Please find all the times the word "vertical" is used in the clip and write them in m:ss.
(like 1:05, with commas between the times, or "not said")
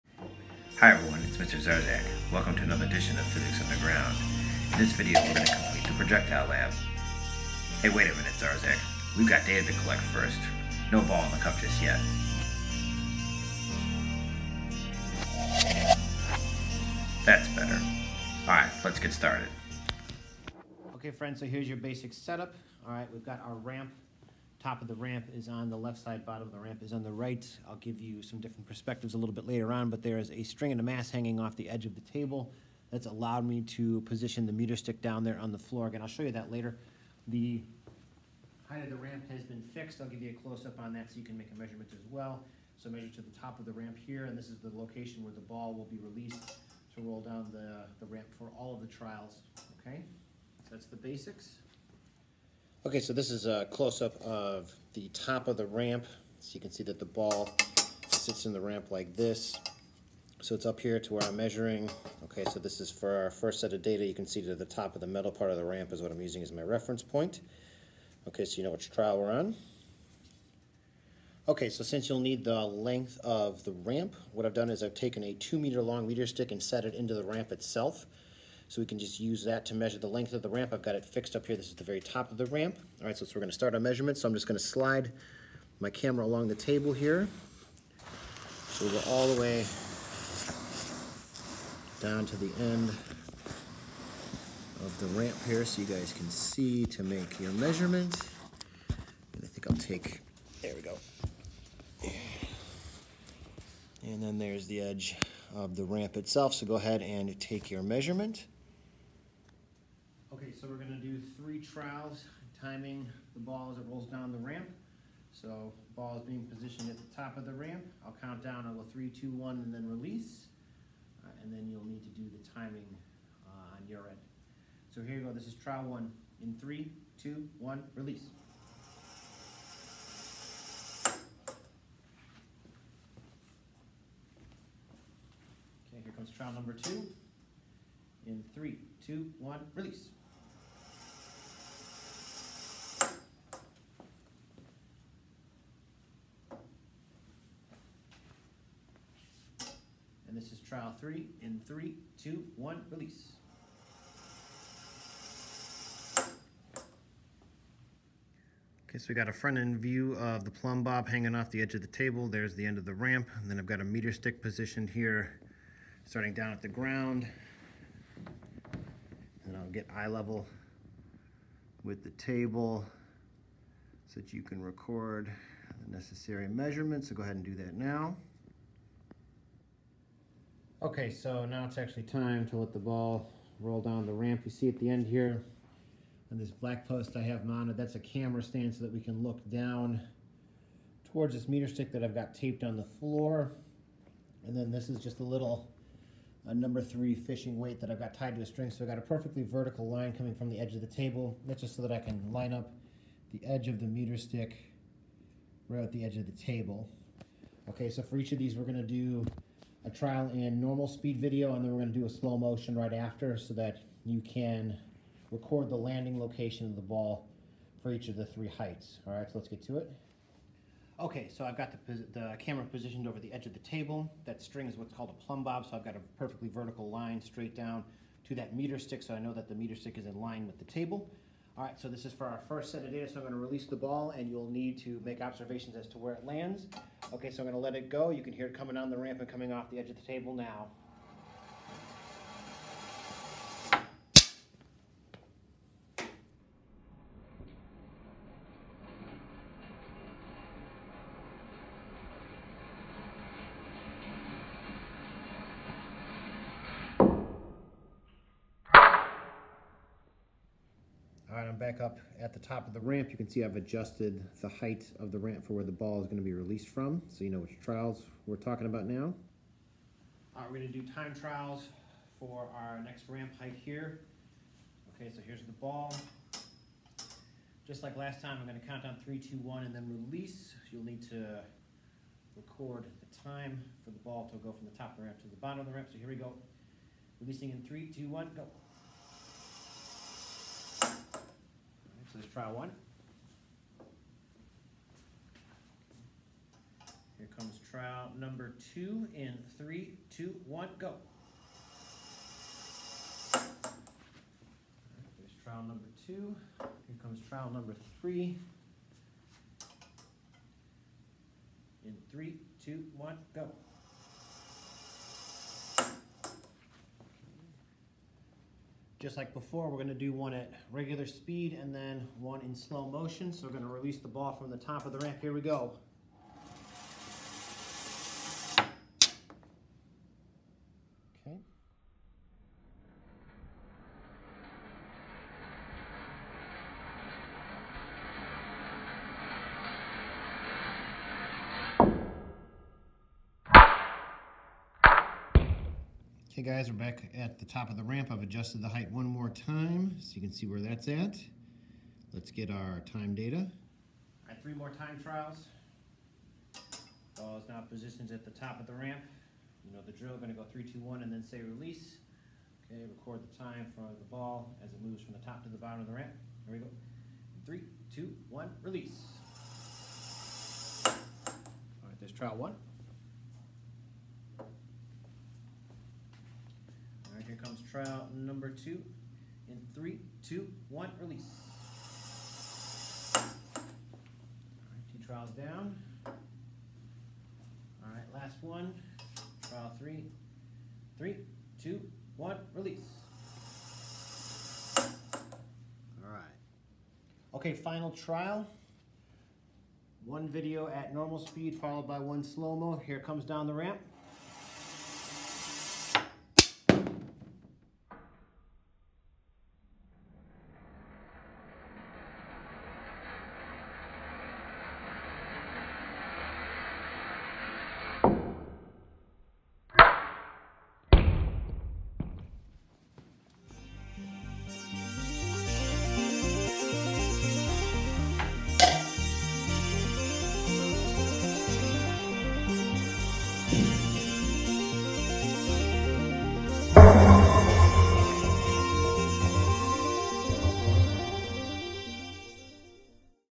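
3:19, 3:46.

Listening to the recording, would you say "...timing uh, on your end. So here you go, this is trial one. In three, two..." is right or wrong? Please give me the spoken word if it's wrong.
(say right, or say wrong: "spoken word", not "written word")
right.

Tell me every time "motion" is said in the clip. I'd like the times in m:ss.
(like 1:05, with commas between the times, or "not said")
3:32, 5:22.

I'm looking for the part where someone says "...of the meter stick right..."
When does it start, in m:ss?
3:23.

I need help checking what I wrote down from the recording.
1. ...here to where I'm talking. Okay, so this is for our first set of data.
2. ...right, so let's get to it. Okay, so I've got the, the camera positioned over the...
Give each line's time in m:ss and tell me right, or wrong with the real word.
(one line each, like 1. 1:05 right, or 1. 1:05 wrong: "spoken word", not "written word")
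1. 1:00 wrong: "measuring", not "talking"
2. 3:39 right.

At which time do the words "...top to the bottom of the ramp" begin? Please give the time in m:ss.
6:05.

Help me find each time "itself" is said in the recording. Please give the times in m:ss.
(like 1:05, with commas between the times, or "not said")
1:17, 1:46.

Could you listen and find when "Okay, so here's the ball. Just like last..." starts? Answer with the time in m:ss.
4:34.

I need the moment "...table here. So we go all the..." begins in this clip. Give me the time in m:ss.
1:26.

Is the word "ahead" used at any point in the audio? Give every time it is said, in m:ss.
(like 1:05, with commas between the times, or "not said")
1:46, 2:57.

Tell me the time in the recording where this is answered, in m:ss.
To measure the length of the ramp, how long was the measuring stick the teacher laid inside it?
1:15.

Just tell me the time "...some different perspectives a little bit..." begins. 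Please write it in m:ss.
0:28.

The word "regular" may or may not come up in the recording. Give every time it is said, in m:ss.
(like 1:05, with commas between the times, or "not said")
5:20.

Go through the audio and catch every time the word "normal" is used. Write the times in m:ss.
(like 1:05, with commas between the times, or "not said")
3:30, 6:40.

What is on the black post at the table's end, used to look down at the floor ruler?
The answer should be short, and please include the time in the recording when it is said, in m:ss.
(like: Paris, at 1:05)
camera stand, at 3:07.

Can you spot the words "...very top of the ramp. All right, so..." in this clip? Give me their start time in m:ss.
1:21.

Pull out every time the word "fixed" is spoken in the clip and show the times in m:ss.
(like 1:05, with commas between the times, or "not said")
0:39, 1:21.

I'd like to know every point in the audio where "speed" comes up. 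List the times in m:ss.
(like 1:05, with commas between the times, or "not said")
3:30, 5:21, 6:41.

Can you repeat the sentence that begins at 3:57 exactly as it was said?
Okay, so I'm gonna let it go.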